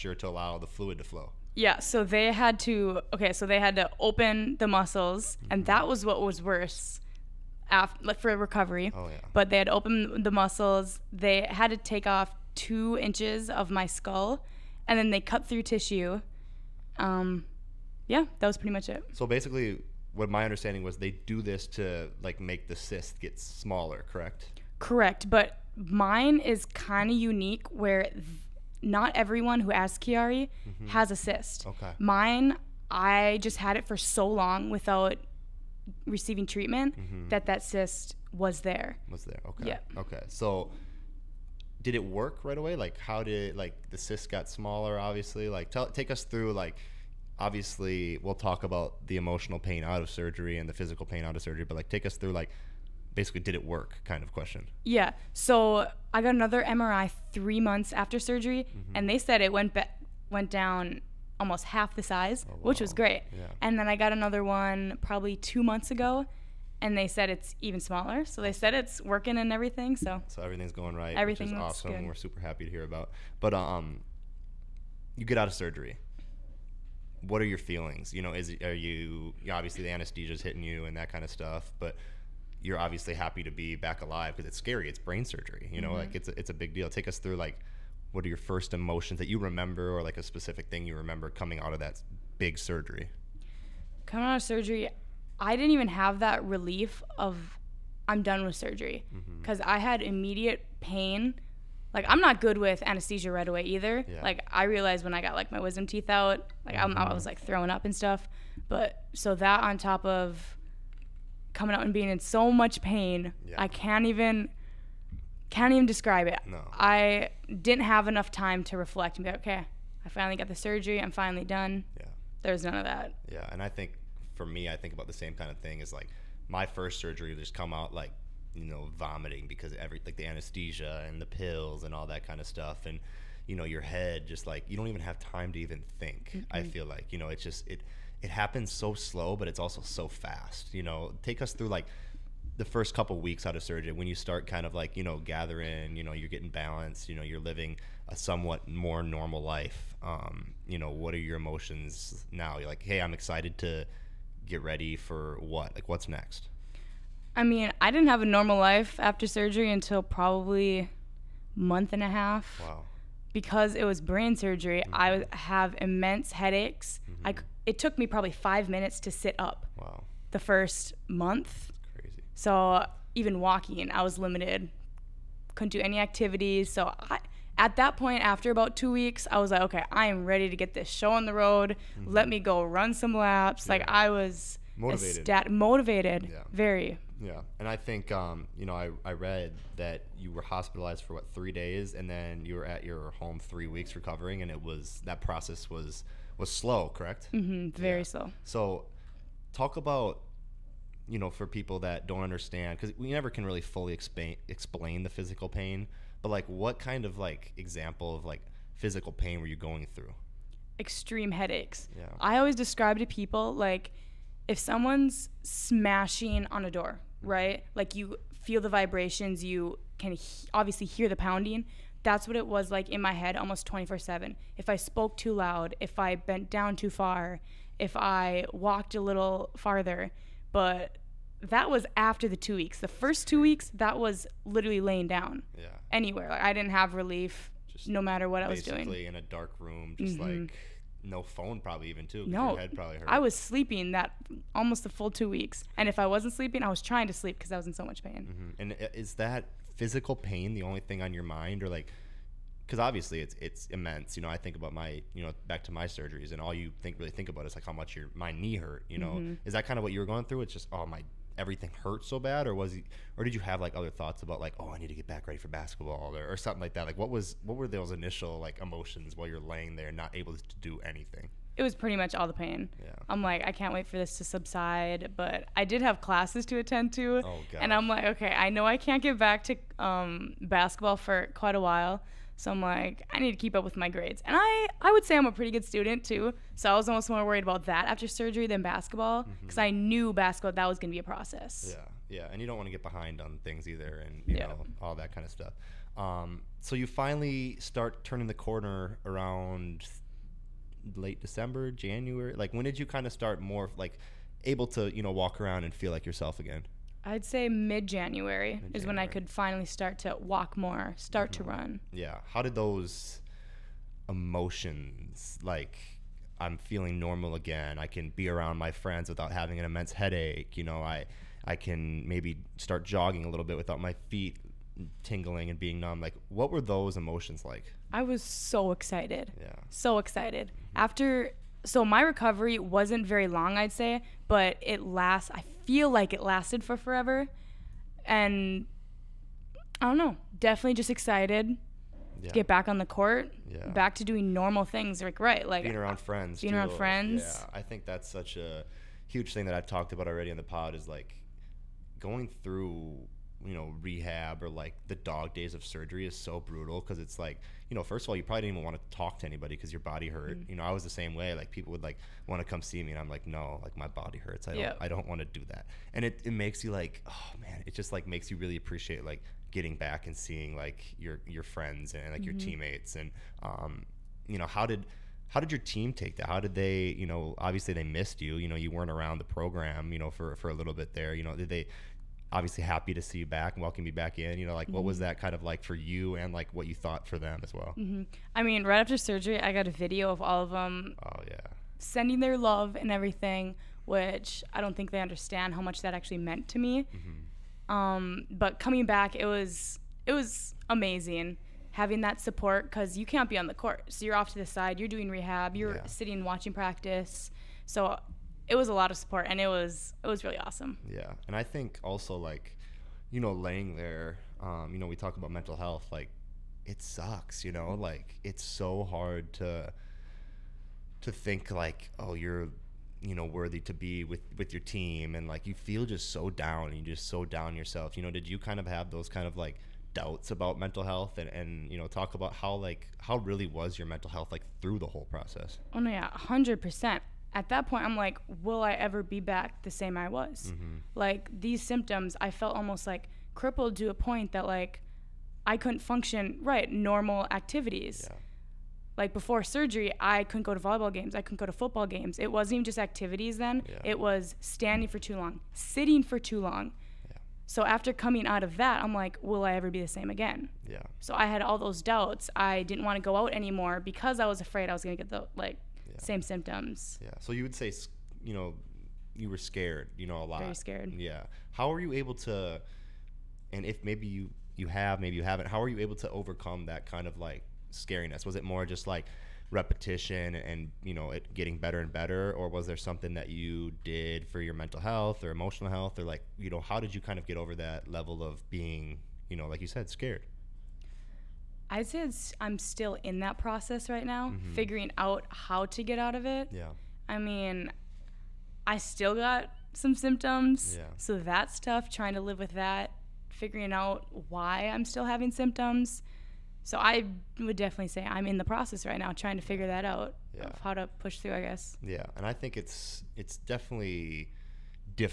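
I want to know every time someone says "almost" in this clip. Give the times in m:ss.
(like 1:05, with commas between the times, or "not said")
1:01, 3:43, 4:04, 4:46, 7:22.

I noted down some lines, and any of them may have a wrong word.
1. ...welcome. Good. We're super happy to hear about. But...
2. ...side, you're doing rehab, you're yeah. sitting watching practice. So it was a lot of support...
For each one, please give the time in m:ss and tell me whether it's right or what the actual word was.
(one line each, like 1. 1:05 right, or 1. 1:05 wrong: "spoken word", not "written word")
1. 1:11 wrong: "awesome", not "welcome"
2. 6:44 right.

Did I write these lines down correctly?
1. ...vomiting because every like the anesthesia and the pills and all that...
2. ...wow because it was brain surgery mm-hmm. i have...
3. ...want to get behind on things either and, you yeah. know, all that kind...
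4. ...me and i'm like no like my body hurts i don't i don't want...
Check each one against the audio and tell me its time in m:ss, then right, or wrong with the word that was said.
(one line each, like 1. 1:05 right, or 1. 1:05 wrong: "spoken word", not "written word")
1. 2:08 right
2. 2:42 right
3. 4:52 right
4. 6:02 right.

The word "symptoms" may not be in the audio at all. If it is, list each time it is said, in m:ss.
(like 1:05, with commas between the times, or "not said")
7:21, 7:46, 8:19, 8:25.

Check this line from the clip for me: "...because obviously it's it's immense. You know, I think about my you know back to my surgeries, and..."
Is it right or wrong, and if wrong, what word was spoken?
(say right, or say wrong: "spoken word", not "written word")
right.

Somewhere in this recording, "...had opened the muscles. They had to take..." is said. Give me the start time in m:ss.
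0:09.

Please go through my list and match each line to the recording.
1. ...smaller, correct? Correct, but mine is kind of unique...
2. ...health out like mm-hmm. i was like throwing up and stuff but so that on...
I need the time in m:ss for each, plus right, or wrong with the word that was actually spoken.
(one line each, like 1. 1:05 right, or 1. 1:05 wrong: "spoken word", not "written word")
1. 0:23 right
2. 1:45 wrong: "teeth", not "health".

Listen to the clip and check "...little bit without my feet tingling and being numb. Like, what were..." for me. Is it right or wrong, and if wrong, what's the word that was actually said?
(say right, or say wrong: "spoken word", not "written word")
right.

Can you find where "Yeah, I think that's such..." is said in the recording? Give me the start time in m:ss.
5:47.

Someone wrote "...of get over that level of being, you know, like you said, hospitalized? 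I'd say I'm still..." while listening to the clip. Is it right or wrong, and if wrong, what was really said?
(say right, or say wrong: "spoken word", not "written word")
wrong: "scared", not "hospitalized".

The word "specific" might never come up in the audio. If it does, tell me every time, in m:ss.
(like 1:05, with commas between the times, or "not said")
1:30.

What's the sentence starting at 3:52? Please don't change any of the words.
The first two weeks, that was literally laying down.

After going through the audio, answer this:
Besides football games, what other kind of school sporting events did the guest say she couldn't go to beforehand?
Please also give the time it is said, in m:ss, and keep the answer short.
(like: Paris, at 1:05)
volleyball games, at 7:30.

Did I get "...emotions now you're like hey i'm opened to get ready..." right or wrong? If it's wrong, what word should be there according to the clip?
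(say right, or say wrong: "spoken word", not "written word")
wrong: "excited", not "opened".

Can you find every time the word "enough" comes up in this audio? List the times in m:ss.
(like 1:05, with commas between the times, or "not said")
1:58.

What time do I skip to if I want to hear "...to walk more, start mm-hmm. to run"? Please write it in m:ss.
5:09.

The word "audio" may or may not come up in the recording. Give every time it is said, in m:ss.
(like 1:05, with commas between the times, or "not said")
not said.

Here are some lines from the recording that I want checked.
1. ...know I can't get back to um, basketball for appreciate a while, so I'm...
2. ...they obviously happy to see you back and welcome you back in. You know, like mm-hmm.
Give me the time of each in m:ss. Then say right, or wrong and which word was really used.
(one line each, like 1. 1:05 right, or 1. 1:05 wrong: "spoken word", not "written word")
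1. 4:38 wrong: "quite", not "appreciate"
2. 6:21 right.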